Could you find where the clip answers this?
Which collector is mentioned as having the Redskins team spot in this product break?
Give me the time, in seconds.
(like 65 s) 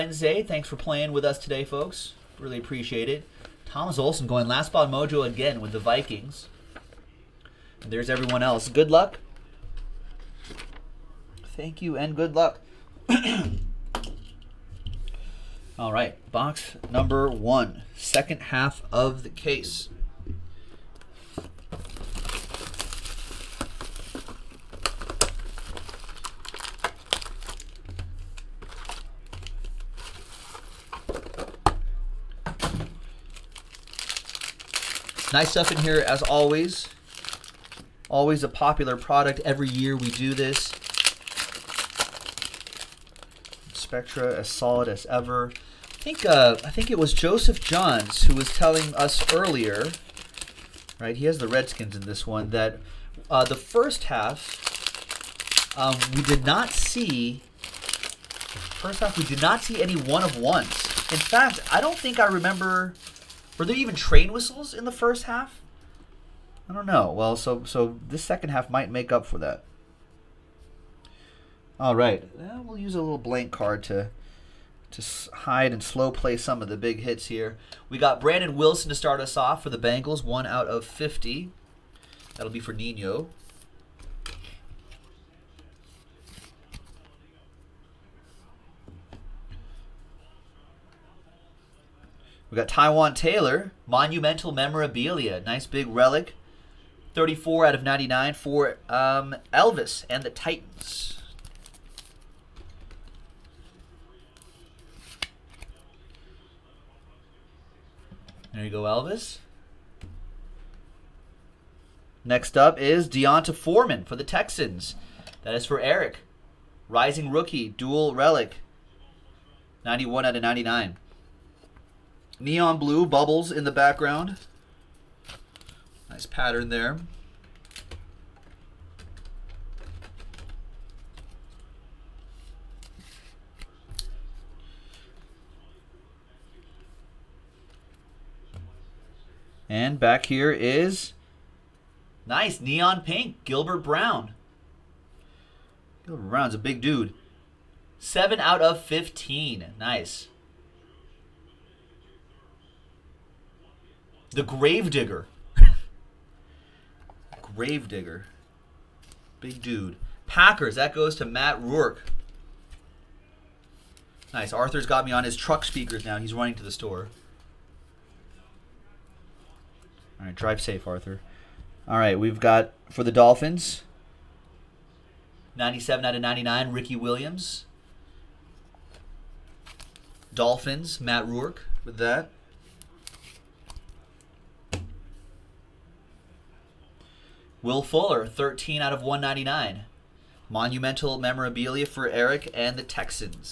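47 s.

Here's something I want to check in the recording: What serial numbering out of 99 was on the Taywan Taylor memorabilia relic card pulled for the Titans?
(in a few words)
34.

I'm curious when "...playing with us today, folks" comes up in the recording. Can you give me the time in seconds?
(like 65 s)
0 s.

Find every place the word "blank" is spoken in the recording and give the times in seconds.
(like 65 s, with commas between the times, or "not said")
73 s.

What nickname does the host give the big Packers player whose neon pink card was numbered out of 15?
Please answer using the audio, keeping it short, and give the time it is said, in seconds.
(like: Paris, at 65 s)
The Gravedigger, at 154 s.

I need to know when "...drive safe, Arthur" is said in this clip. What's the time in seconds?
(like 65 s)
170 s.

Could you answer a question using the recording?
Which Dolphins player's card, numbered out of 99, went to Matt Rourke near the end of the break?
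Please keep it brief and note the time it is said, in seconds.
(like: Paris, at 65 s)
Ricky Williams, at 176 s.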